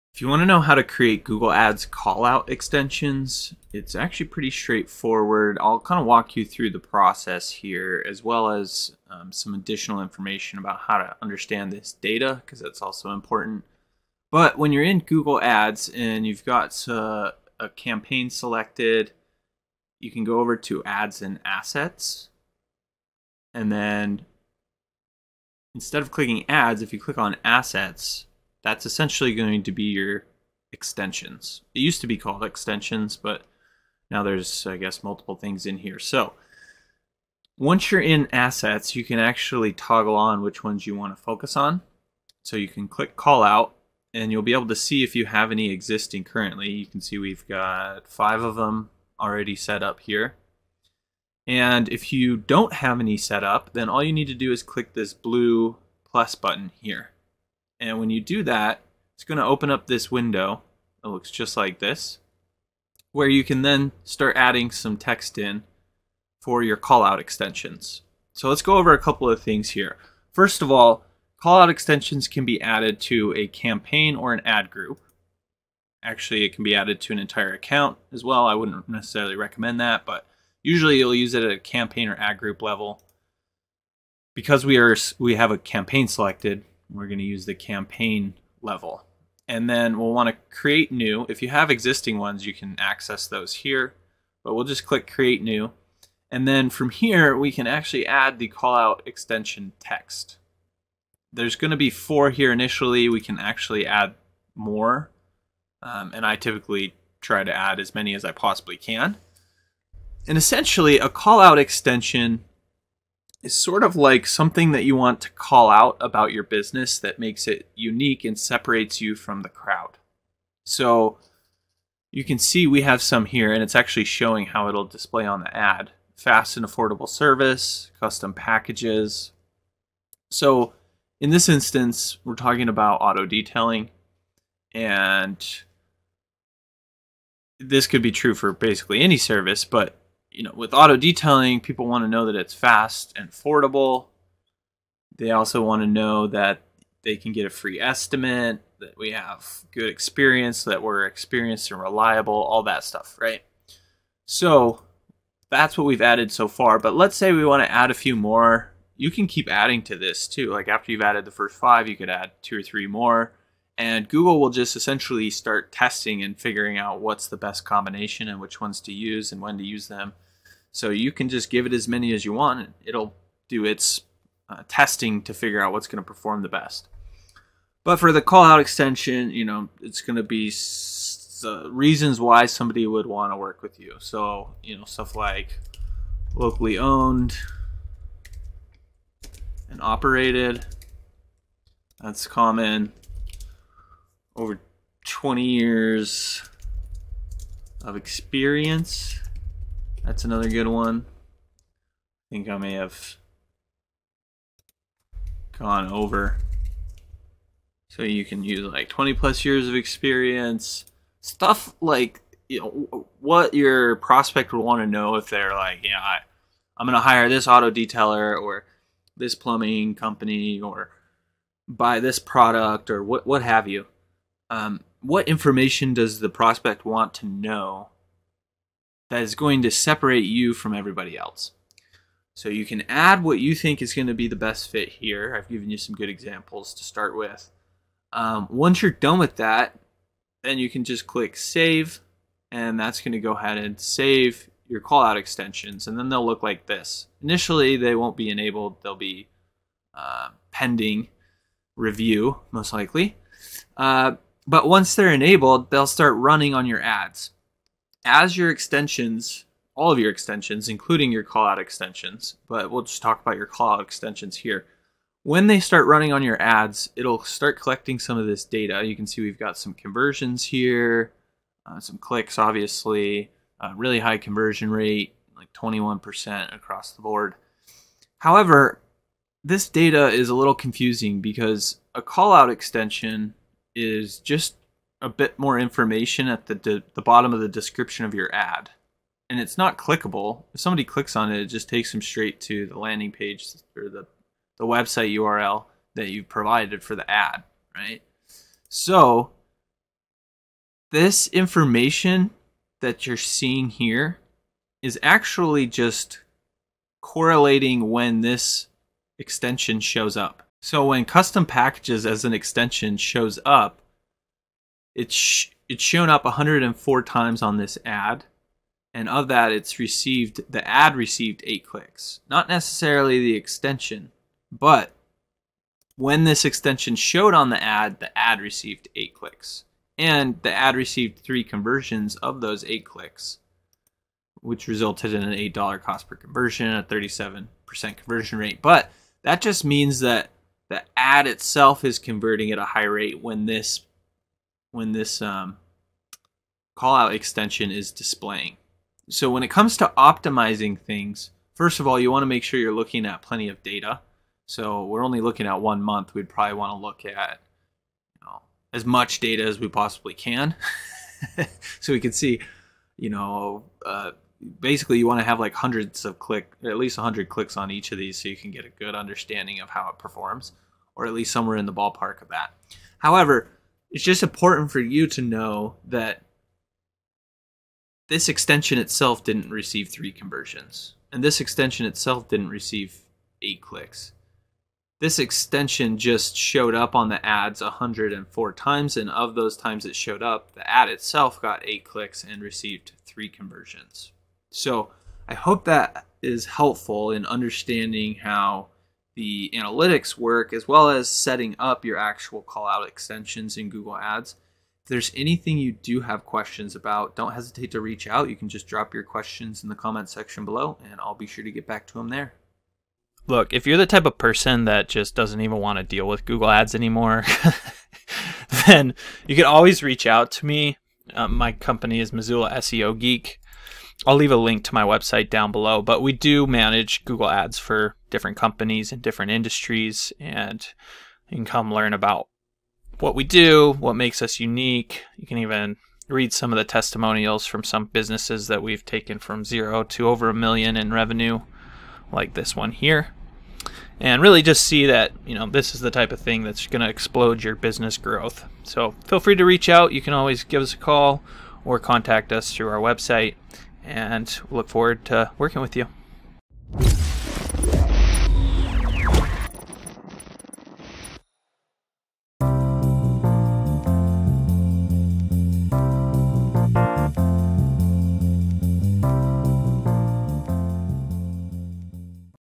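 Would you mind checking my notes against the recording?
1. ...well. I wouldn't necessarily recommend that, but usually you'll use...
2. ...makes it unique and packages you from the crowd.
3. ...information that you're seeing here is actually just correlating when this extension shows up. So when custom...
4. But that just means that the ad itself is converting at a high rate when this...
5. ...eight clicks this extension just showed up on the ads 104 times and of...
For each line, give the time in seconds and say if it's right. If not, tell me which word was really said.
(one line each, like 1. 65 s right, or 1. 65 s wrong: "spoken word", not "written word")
1. 78 s right
2. 117 s wrong: "separates", not "packages"
3. 301 s right
4. 338 s right
5. 383 s right.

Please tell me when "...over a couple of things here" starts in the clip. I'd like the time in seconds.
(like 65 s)
68 s.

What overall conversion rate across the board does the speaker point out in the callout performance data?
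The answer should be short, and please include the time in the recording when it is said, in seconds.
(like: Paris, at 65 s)
21%, at 275 s.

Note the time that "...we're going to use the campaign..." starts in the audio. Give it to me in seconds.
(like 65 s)
86 s.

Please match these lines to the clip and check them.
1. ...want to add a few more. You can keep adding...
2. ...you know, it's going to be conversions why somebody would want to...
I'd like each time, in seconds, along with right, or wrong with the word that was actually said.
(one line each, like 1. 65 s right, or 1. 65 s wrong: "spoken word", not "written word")
1. 157 s right
2. 179 s wrong: "reasons", not "conversions".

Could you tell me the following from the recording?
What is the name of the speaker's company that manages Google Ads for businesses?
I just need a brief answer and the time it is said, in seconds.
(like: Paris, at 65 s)
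Missoula SEO Geek, at 422 s.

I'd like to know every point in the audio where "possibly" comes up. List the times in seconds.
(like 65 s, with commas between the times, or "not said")
108 s, 359 s.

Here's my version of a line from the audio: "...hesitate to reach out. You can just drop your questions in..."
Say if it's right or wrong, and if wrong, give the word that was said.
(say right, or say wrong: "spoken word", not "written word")
right.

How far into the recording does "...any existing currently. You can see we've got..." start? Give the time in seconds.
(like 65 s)
45 s.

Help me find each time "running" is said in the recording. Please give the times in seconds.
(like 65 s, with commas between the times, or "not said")
256 s, 265 s.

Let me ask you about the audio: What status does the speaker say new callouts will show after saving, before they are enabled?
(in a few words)
pending review.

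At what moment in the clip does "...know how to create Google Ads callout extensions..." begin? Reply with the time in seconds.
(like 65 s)
0 s.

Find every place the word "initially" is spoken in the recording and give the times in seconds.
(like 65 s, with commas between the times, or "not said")
102 s, 247 s.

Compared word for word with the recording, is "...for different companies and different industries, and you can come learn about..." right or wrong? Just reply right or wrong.
right.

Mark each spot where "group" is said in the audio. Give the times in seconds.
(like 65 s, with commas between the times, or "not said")
74 s, 82 s.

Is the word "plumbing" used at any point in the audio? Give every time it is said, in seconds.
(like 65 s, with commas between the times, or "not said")
219 s.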